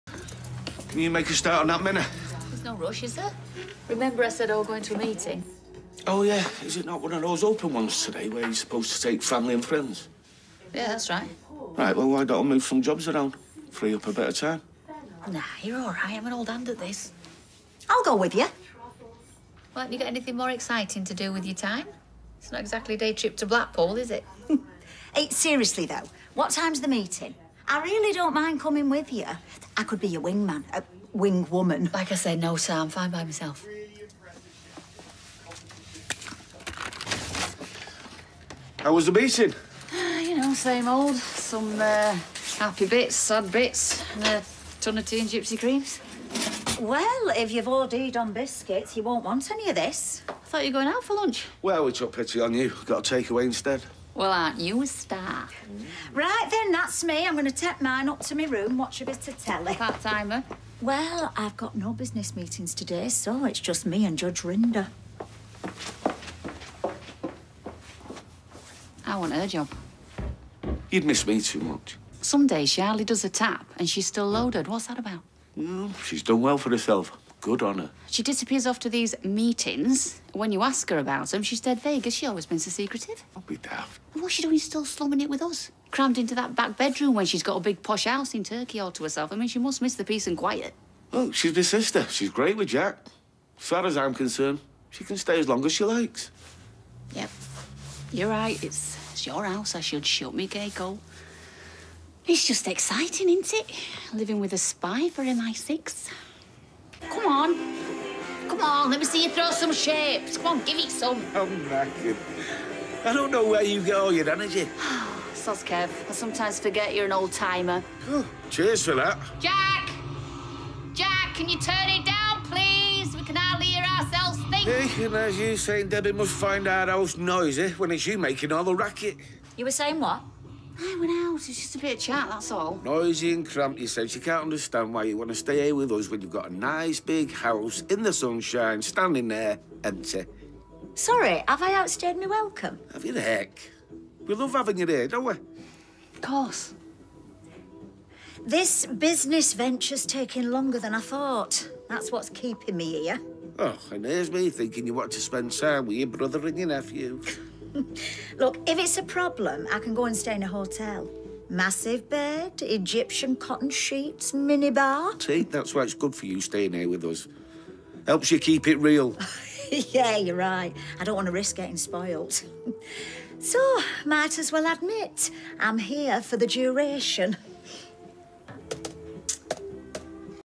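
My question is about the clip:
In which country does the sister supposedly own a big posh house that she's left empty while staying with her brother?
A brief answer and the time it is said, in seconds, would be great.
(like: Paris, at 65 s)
Turkey, at 88 s.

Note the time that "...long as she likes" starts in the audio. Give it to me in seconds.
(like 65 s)
95 s.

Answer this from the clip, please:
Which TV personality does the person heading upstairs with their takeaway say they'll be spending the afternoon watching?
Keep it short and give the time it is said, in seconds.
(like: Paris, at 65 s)
Judge Rinder, at 64 s.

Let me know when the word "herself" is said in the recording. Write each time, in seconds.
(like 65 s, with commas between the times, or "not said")
76 s, 89 s.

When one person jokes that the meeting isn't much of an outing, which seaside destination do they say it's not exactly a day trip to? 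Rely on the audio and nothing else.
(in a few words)
Blackpool.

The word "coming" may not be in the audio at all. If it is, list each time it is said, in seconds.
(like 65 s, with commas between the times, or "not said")
28 s.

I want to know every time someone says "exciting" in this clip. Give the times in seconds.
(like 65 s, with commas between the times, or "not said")
20 s, 102 s.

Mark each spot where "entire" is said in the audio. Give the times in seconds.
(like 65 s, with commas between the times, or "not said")
not said.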